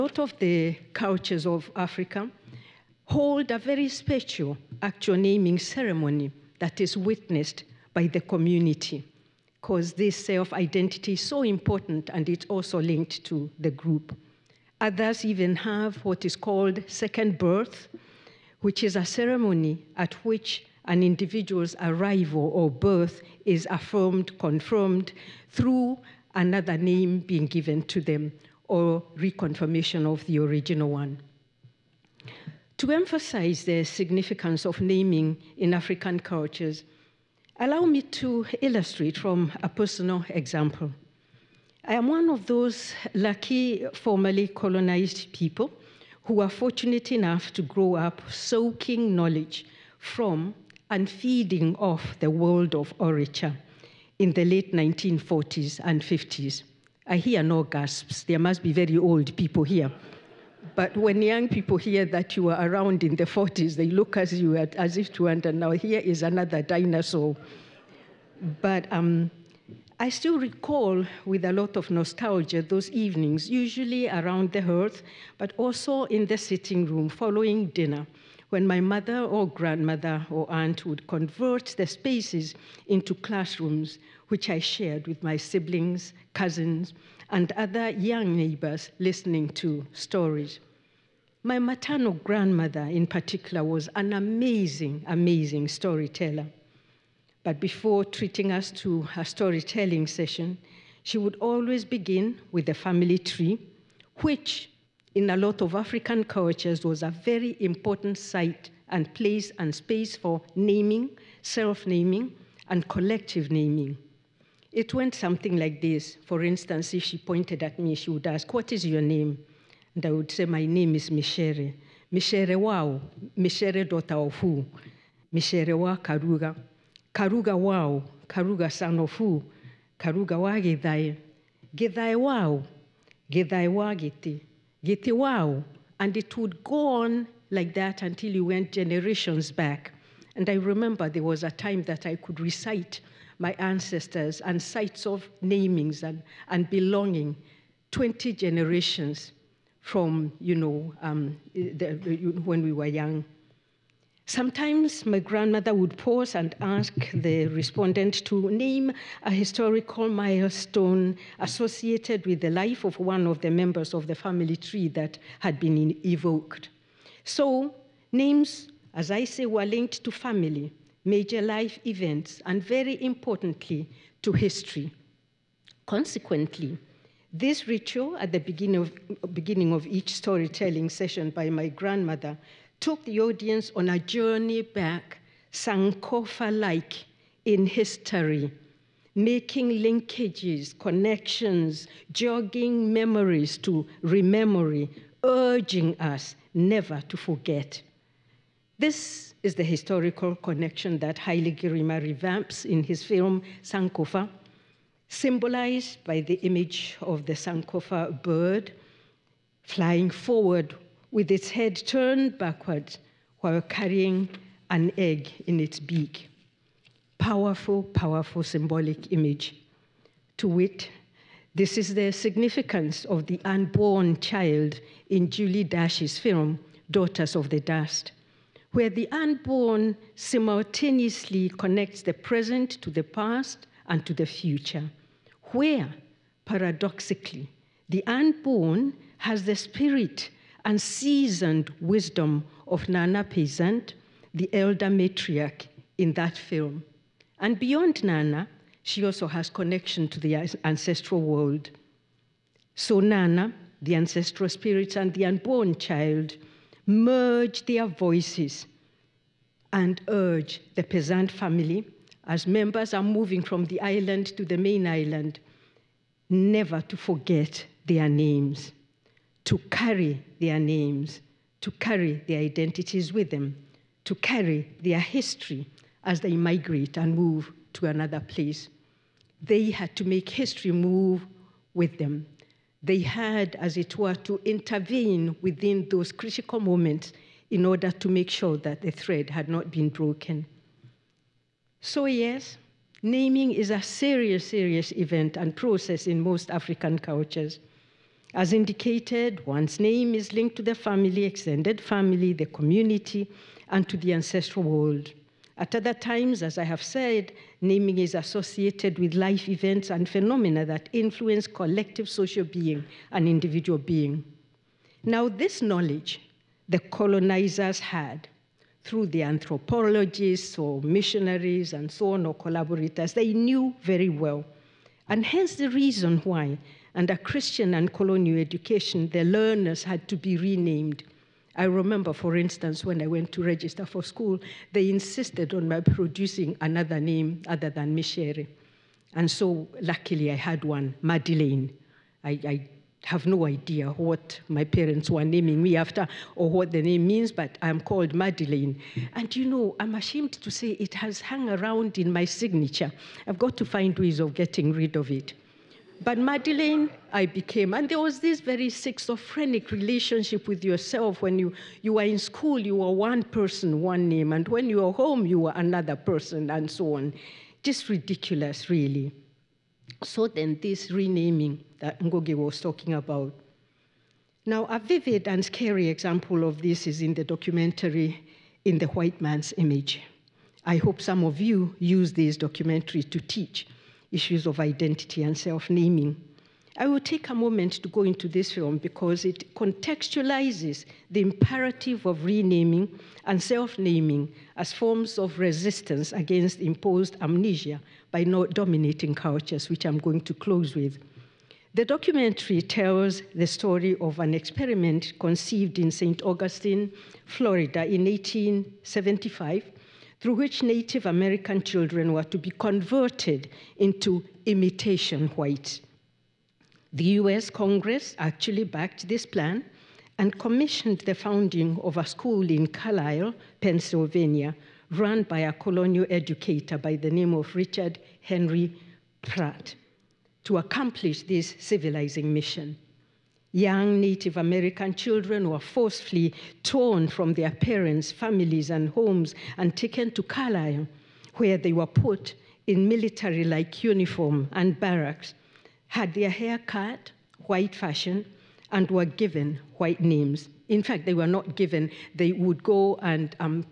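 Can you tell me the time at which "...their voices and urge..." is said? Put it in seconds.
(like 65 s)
257 s.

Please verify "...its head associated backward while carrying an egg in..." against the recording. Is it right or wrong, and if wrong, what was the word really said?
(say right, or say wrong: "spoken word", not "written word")
wrong: "turned", not "associated".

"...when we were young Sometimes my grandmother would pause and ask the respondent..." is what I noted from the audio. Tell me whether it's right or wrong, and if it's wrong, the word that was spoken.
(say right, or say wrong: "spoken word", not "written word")
right.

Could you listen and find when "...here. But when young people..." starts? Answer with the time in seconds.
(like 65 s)
59 s.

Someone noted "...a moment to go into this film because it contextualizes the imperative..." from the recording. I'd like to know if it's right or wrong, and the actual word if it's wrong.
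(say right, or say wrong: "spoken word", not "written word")
right.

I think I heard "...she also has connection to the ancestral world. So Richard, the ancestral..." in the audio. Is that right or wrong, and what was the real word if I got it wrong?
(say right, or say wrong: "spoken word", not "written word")
wrong: "Nana", not "Richard".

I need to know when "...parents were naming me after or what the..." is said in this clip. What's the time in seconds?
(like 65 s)
344 s.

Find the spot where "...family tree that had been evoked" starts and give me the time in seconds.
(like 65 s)
164 s.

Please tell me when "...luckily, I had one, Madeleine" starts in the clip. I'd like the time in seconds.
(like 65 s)
339 s.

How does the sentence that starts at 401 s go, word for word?
The documentary tells the story of an experiment conceived in St.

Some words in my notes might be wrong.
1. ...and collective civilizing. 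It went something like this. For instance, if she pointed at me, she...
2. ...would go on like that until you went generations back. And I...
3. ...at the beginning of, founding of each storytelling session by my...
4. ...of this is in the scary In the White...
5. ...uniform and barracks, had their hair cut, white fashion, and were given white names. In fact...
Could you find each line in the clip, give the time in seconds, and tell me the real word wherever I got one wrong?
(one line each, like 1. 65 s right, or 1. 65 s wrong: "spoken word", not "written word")
1. 112 s wrong: "naming", not "civilizing"
2. 136 s right
3. 178 s wrong: "beginning", not "founding"
4. 376 s wrong: "documentary", not "scary"
5. 443 s right.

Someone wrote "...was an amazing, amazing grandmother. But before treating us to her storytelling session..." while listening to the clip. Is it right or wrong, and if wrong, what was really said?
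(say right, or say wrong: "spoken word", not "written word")
wrong: "storyteller", not "grandmother".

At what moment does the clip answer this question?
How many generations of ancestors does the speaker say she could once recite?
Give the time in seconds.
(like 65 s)
147 s.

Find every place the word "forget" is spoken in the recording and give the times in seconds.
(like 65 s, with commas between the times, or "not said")
197 s, 266 s.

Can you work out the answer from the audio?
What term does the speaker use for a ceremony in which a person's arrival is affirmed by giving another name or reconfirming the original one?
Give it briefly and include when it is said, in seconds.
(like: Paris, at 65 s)
Second birth, at 16 s.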